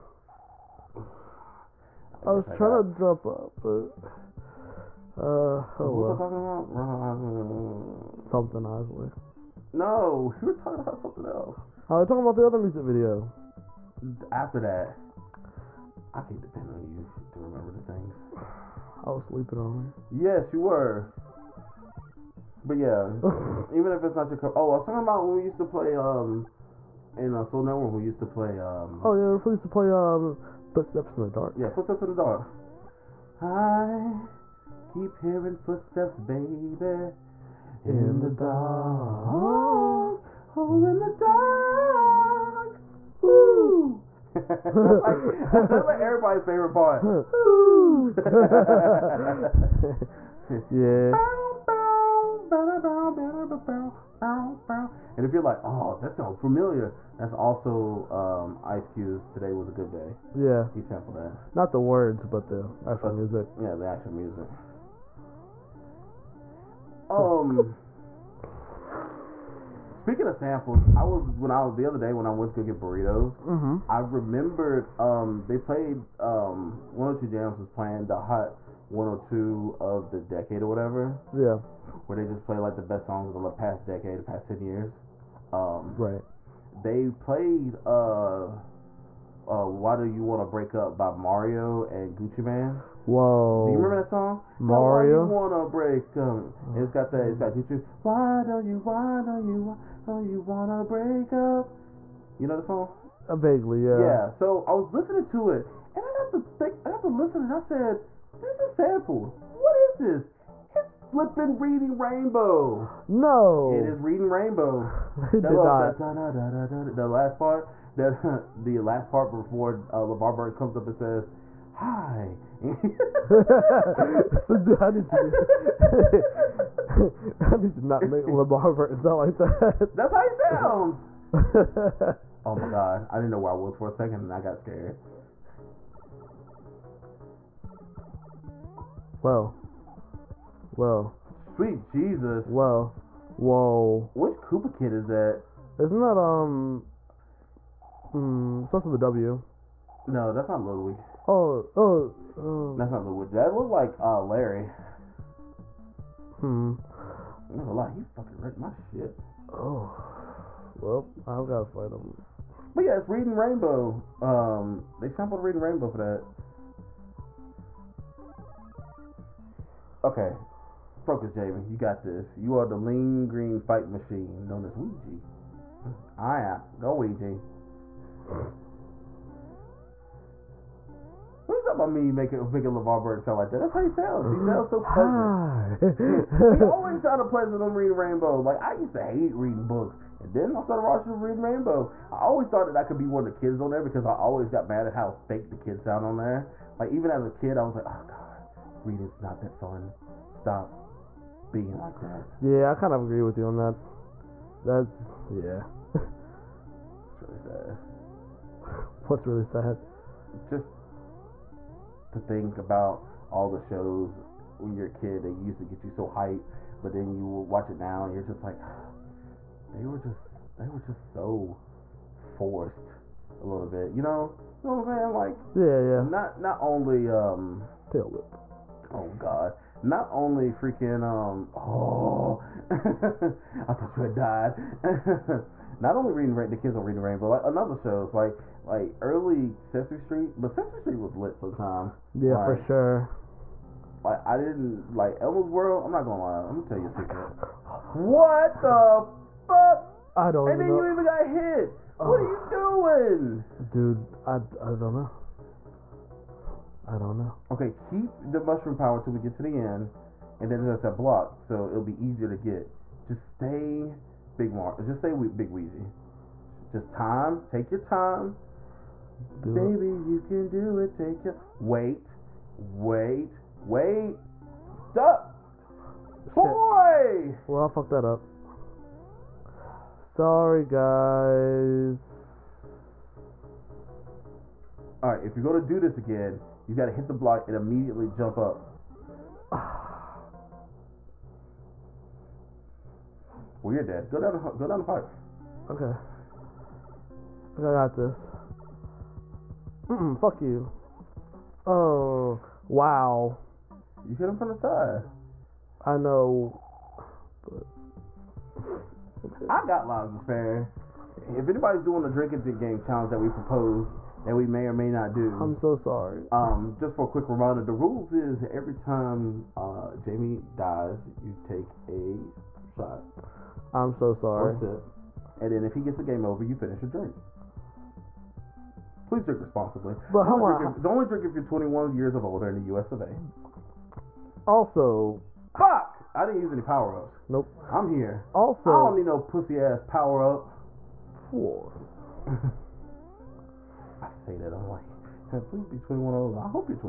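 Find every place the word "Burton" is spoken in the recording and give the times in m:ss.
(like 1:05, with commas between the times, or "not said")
2:00, 2:08, 3:03.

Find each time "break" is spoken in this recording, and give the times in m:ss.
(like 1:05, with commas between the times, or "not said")
1:30, 1:35, 1:40.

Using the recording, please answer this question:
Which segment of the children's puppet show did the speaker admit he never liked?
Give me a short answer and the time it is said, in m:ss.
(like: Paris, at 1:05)
Elmo's World, at 4:05.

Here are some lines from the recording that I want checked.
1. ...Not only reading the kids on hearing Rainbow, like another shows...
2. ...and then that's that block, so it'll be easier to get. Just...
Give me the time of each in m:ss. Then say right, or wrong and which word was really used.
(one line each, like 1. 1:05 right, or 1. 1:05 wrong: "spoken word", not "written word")
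1. 3:55 wrong: "reading", not "hearing"
2. 4:20 right.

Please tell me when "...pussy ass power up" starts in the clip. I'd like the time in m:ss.
5:39.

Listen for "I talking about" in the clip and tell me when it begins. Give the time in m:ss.
0:06.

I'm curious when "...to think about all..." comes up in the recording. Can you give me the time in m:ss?
3:32.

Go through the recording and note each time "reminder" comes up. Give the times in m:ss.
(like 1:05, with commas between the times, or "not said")
5:17.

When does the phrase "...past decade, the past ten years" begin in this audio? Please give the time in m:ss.
1:23.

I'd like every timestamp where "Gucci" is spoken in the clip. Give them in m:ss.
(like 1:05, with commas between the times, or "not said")
1:32, 1:37.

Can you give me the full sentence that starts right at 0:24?
Oh, I was talking about when we used to play um in uh, Soul Network.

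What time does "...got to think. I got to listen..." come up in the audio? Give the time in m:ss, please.
1:46.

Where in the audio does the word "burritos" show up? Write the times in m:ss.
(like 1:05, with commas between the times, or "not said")
1:12.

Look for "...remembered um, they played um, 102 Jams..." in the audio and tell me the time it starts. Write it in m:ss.
1:13.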